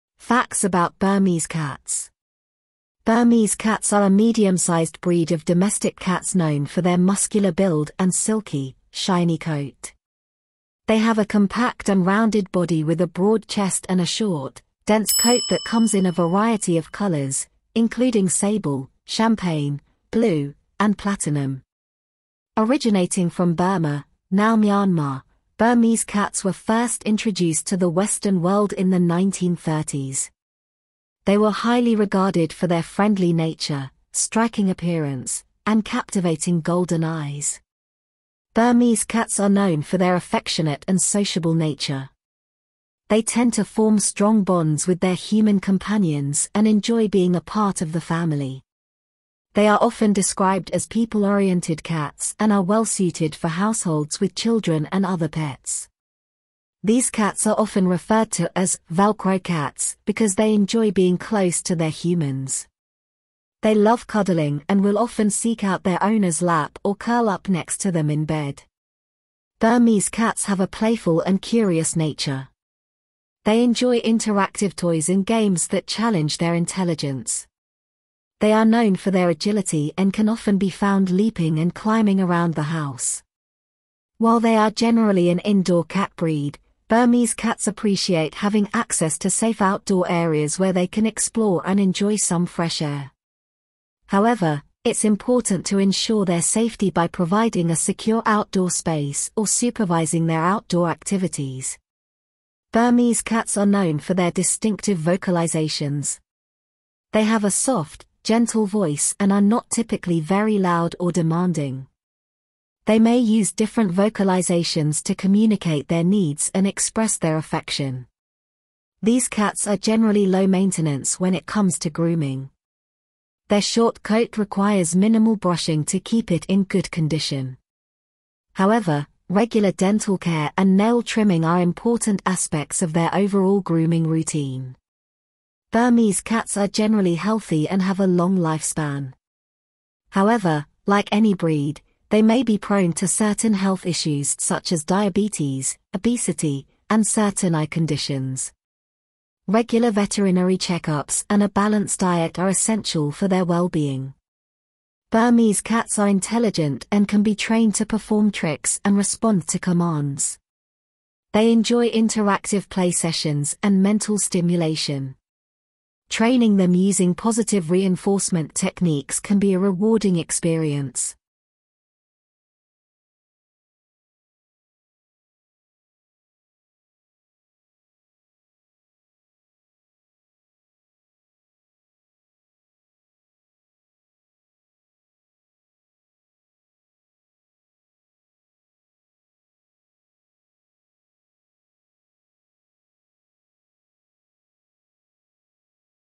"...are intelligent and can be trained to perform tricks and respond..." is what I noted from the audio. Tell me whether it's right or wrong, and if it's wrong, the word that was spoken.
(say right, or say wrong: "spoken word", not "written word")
right.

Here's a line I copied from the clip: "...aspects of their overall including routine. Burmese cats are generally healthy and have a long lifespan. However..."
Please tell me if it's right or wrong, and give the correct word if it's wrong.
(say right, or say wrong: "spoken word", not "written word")
wrong: "grooming", not "including".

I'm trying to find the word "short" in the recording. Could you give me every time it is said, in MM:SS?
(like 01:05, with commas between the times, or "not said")
00:14, 02:03.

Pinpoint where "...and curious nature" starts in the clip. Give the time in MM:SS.
01:11.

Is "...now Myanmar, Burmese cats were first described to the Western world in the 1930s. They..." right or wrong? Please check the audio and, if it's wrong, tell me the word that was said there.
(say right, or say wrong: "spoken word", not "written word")
wrong: "introduced", not "described".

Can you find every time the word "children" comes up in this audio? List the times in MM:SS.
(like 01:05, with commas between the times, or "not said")
00:54.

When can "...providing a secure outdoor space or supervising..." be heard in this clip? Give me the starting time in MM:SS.
01:37.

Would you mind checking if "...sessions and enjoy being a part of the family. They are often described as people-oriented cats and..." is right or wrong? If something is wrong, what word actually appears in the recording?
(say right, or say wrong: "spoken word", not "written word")
wrong: "companions", not "sessions".